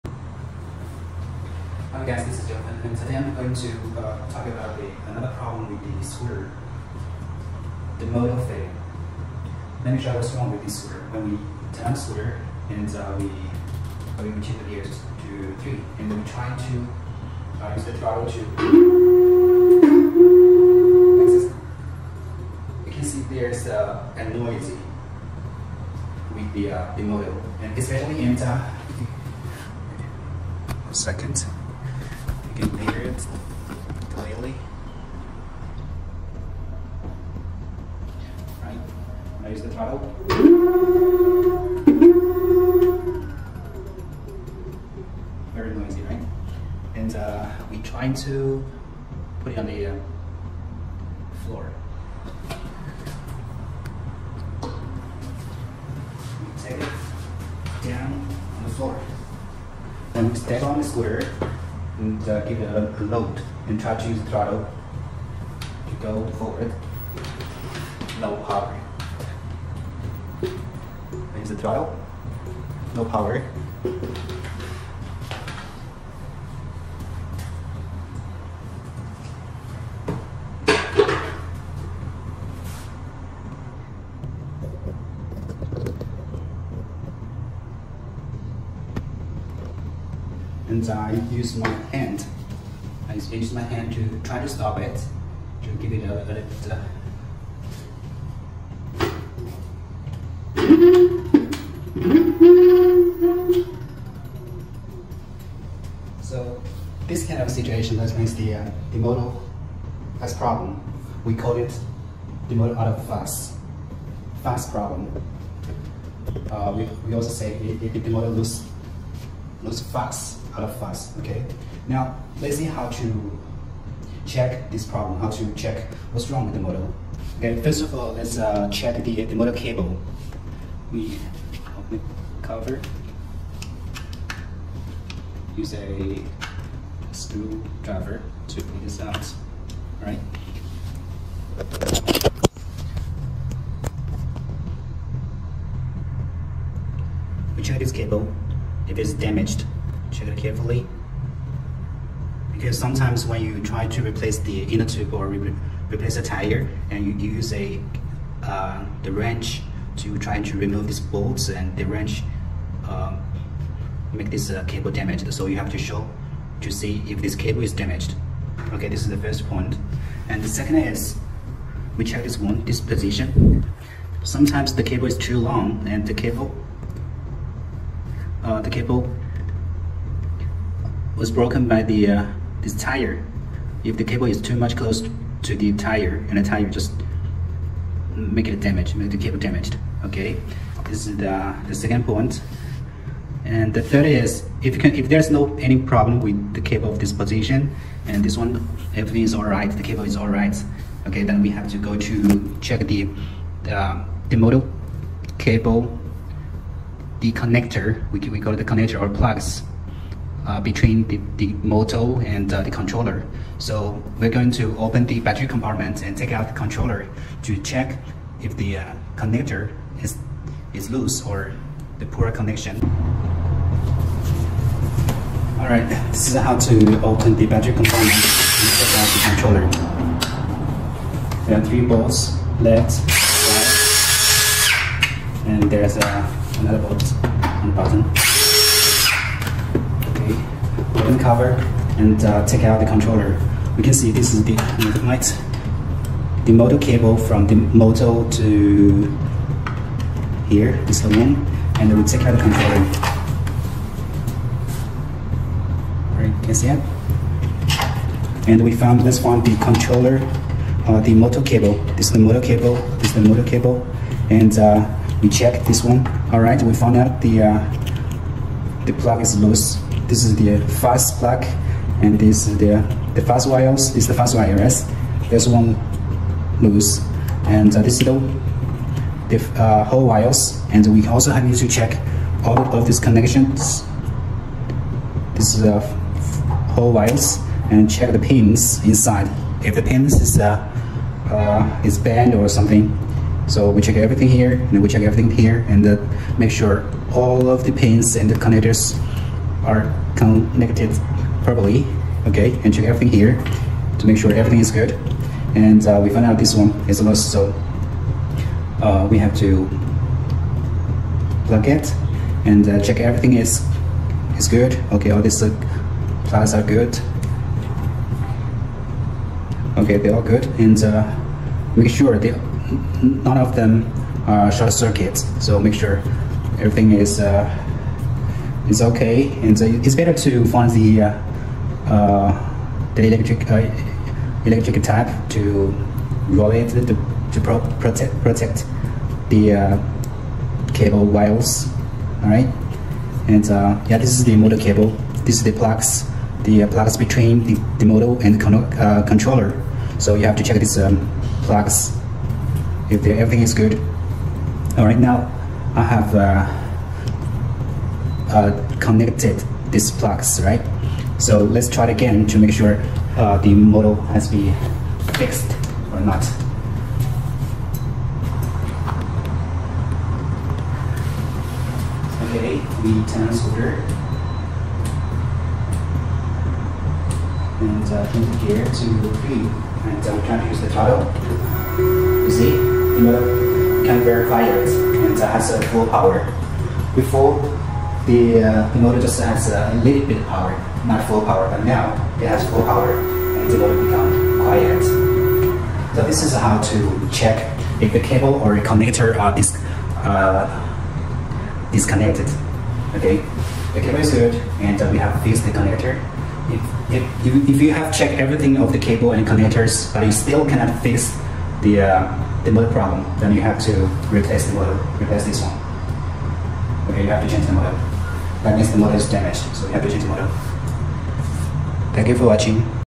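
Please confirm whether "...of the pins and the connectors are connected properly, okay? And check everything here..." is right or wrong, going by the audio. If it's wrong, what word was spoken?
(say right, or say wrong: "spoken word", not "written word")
right.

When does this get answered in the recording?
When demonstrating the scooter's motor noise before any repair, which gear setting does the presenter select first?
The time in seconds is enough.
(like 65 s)
15 s.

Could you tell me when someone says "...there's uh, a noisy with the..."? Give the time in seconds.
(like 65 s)
23 s.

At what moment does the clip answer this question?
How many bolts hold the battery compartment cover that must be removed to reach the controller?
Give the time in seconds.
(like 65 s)
231 s.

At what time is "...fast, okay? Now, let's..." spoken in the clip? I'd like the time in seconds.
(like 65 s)
120 s.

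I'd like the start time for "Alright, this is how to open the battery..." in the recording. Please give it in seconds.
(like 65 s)
225 s.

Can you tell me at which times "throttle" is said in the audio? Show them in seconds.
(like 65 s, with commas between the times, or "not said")
17 s, 39 s, 64 s, 71 s, 380 s.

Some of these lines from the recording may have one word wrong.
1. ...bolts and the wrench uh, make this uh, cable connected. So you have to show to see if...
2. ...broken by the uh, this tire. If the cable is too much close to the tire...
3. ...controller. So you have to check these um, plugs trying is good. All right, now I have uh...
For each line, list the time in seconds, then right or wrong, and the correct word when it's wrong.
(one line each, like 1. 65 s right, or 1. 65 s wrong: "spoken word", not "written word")
1. 160 s wrong: "damaged", not "connected"
2. 181 s right
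3. 349 s wrong: "everything", not "trying".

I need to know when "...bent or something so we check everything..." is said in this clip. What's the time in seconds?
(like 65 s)
291 s.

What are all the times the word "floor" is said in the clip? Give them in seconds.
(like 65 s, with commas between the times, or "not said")
51 s, 58 s.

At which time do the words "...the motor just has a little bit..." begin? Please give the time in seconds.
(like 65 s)
388 s.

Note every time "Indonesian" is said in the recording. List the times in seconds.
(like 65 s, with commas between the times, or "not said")
not said.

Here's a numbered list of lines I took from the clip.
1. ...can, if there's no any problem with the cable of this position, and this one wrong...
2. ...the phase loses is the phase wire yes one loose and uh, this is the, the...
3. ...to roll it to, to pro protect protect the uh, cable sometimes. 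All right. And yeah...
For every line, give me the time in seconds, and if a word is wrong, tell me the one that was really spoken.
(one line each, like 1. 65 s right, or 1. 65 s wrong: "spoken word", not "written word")
1. 194 s wrong: "everything", not "wrong"
2. 273 s wrong: "wires", not "loses"
3. 335 s wrong: "wires", not "sometimes".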